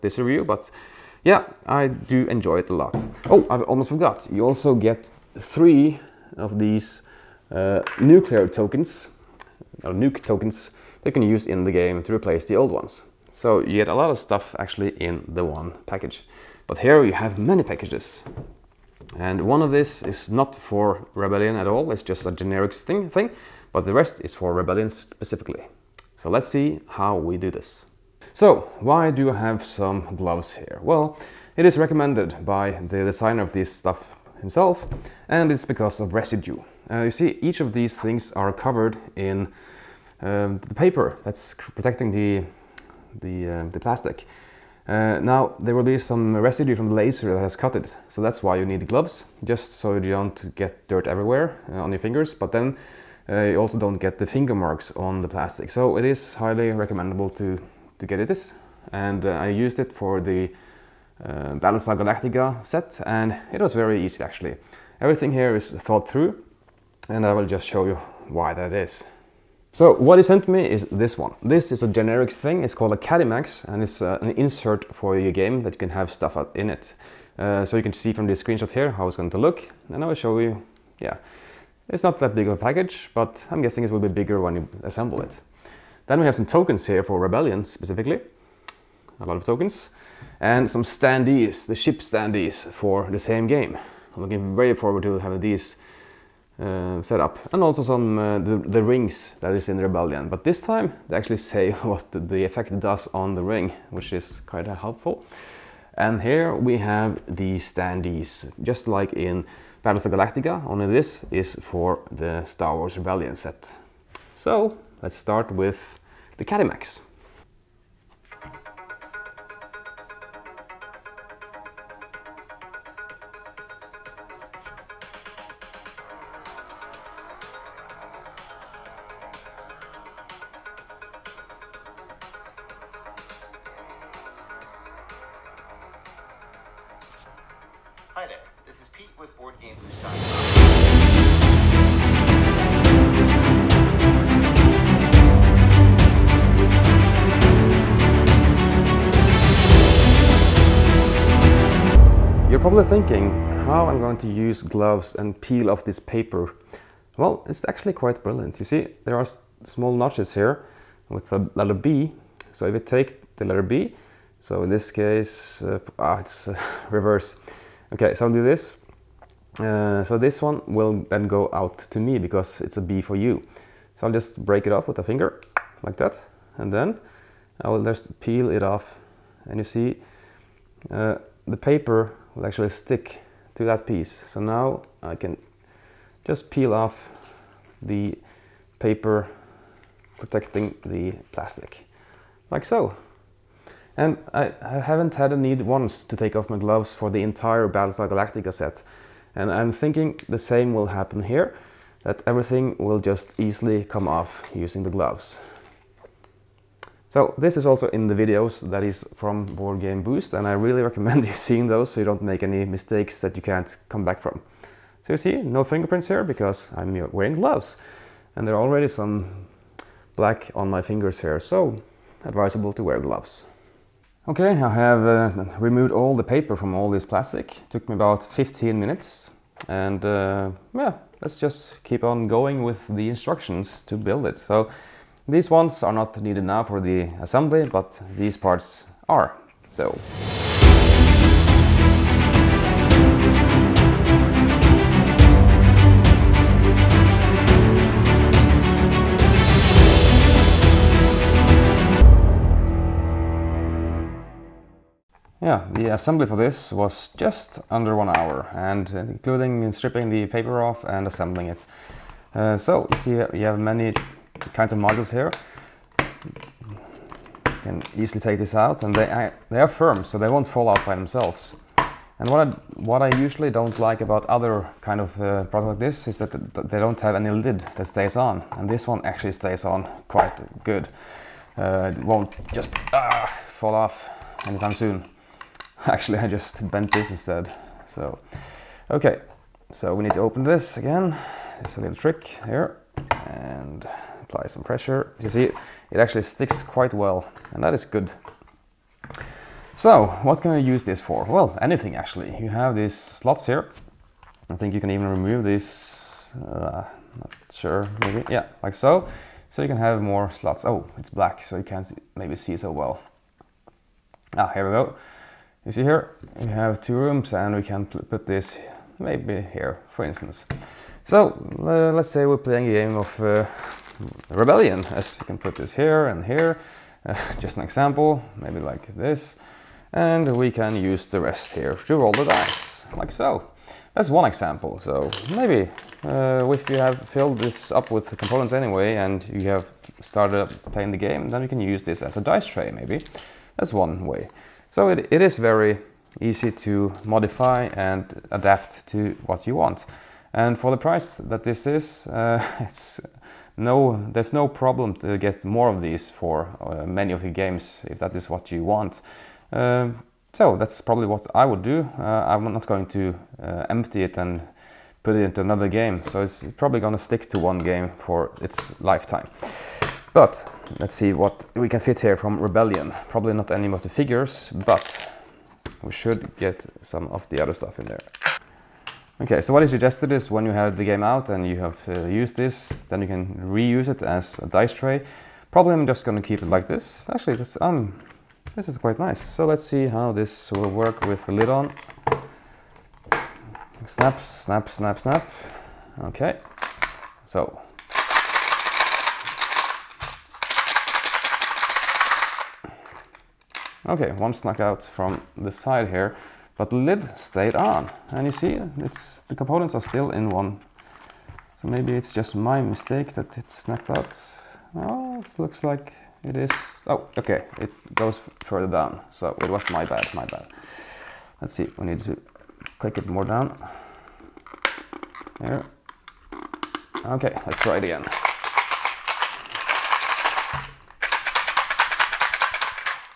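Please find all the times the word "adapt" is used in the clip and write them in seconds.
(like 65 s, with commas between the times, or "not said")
348 s.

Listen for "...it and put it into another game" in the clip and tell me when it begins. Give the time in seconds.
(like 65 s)
364 s.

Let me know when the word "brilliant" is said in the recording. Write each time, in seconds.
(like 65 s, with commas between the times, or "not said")
158 s.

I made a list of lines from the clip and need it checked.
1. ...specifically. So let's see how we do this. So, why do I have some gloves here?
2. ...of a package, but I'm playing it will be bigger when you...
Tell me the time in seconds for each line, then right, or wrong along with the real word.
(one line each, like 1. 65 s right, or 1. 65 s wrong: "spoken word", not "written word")
1. 24 s right
2. 82 s wrong: "guessing", not "playing".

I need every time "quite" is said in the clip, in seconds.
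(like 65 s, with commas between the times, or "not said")
157 s, 280 s, 296 s, 388 s.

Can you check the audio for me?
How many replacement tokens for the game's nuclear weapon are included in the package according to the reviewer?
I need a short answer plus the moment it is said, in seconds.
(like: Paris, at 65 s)
3, at 5 s.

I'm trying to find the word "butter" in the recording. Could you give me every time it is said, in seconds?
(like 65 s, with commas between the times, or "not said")
not said.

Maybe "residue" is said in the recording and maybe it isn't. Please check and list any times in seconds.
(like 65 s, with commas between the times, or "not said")
36 s, 46 s.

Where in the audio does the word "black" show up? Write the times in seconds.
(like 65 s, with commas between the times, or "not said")
220 s, 311 s.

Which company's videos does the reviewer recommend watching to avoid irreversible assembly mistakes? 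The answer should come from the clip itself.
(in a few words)
Board Game Boost.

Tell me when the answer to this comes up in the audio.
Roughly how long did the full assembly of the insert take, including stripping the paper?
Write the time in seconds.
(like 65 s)
257 s.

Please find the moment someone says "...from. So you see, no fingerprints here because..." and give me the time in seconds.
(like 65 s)
214 s.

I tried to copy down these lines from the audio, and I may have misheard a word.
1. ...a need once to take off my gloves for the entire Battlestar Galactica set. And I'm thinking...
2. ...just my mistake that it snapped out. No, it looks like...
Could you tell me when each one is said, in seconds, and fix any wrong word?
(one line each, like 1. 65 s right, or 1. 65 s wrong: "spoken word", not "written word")
1. 195 s right
2. 412 s right.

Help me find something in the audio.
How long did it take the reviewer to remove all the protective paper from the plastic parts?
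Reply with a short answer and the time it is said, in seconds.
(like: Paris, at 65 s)
15 minutes, at 228 s.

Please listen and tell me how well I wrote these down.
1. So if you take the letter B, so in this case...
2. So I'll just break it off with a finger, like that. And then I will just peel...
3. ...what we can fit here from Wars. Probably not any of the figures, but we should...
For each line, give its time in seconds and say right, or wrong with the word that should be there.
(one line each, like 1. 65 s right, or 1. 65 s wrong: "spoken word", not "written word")
1. 162 s right
2. 173 s right
3. 371 s wrong: "Rebellion", not "Wars".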